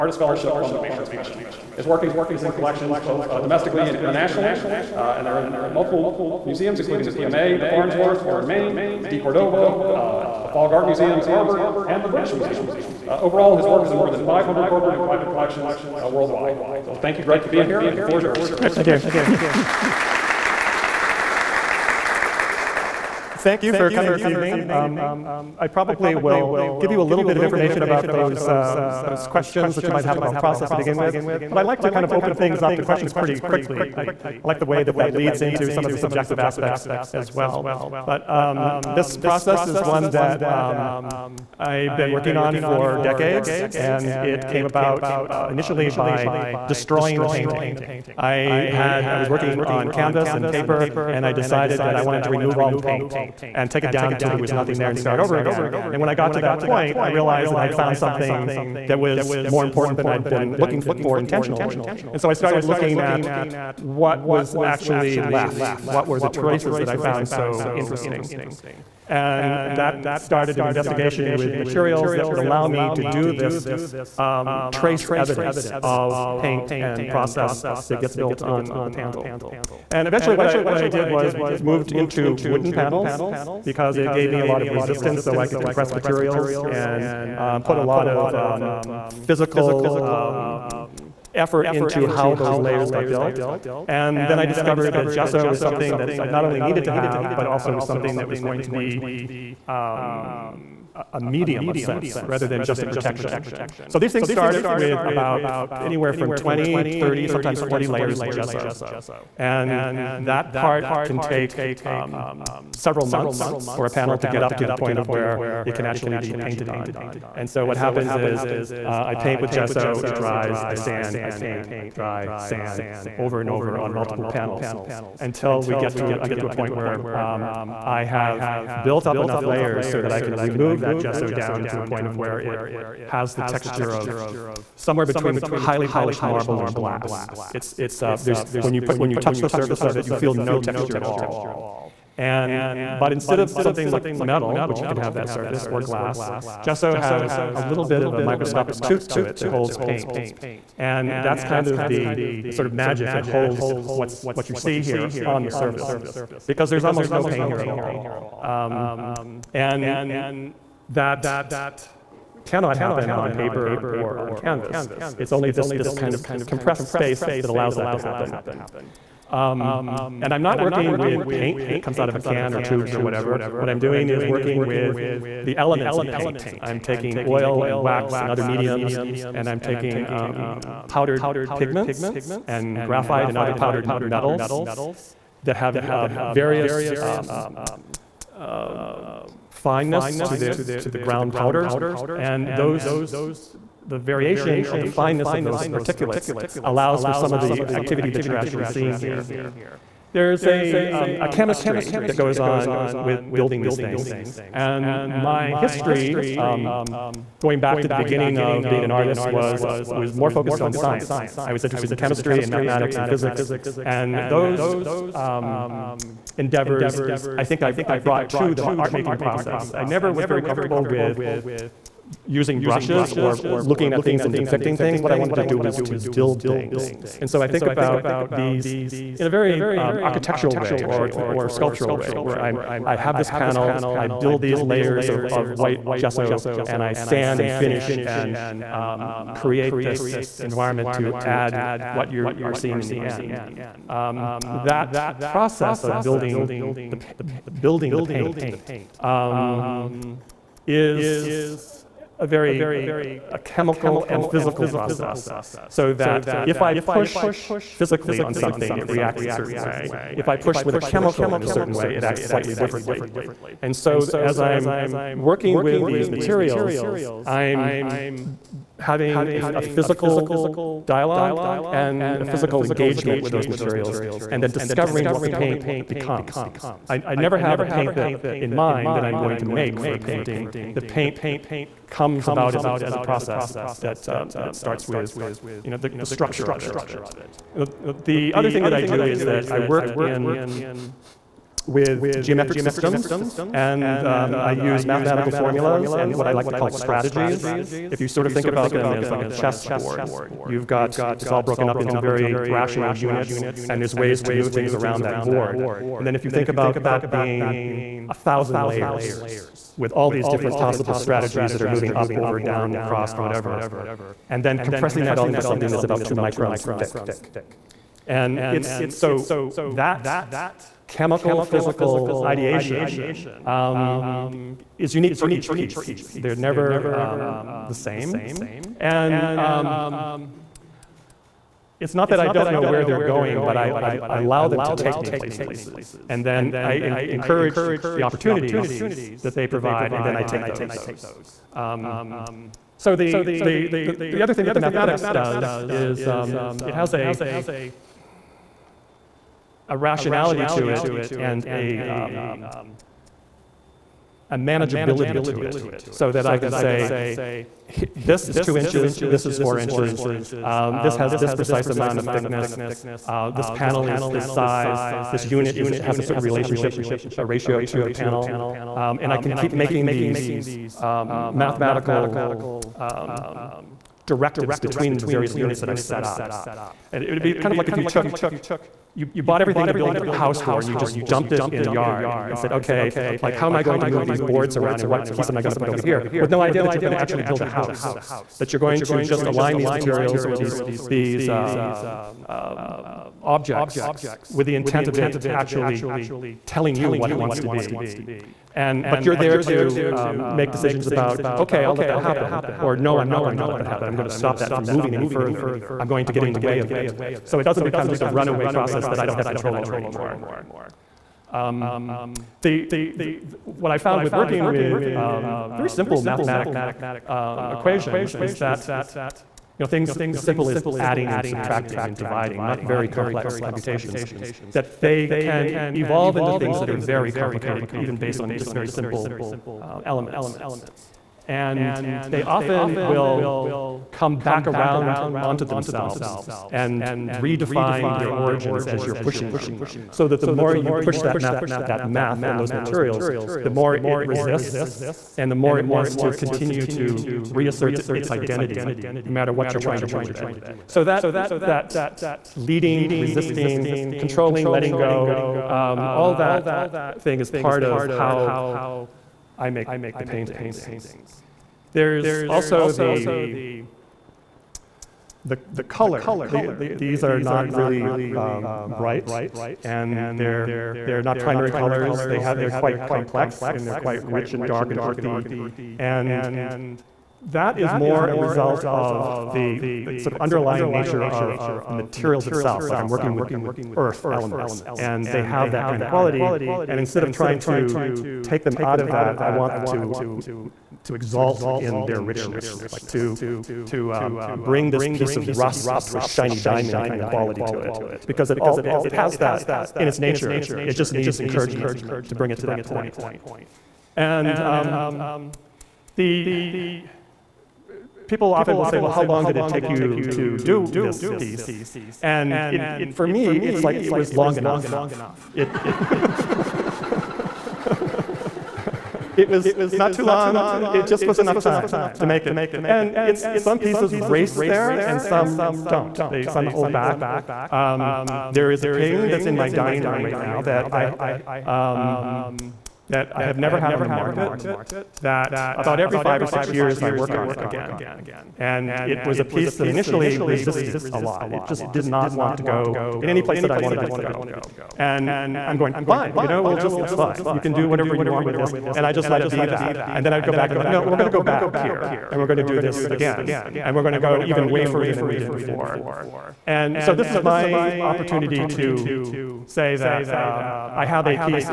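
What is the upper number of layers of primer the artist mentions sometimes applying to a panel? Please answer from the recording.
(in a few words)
40.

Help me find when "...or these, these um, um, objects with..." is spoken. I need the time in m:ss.
6:30.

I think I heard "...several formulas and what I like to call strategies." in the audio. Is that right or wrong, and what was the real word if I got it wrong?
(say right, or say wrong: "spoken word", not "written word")
wrong: "mathematical", not "several".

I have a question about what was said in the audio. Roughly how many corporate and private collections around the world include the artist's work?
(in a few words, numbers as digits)
500.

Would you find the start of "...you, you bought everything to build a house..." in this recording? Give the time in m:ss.
6:18.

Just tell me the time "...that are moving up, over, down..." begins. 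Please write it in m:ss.
5:11.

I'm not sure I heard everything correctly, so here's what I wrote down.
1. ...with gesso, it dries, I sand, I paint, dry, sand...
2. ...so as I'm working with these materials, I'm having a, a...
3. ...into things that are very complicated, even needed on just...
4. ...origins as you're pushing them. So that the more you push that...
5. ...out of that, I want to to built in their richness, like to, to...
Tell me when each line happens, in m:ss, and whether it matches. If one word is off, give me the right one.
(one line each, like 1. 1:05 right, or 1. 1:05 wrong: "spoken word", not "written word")
1. 1:59 right
2. 4:23 right
3. 7:06 wrong: "based", not "needed"
4. 7:18 right
5. 8:08 wrong: "exalt", not "built".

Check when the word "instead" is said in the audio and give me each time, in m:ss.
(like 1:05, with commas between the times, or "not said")
2:23, 8:06.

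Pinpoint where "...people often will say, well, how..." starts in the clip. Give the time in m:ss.
8:28.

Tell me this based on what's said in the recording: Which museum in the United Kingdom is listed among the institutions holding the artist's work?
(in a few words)
British Museum.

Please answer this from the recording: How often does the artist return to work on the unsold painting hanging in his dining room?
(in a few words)
Every 5 or 6 years.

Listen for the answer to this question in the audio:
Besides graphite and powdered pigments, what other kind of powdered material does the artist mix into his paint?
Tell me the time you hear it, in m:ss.
3:03.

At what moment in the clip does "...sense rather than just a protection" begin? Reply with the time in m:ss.
1:41.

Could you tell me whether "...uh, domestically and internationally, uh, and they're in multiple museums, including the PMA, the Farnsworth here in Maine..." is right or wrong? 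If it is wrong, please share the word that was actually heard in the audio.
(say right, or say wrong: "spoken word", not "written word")
right.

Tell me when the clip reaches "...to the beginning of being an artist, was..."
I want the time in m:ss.
3:27.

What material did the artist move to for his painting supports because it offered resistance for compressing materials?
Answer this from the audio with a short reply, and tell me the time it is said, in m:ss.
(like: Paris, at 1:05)
Wooden panels, at 1:22.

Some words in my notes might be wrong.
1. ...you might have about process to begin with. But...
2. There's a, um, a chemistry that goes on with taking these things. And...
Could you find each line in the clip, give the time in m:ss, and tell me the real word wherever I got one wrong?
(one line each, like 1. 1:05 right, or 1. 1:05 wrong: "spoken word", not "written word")
1. 0:29 right
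2. 3:20 wrong: "building", not "taking".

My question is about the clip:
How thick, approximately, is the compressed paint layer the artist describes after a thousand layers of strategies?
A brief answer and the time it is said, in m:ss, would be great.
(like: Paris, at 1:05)
2 microns, at 5:16.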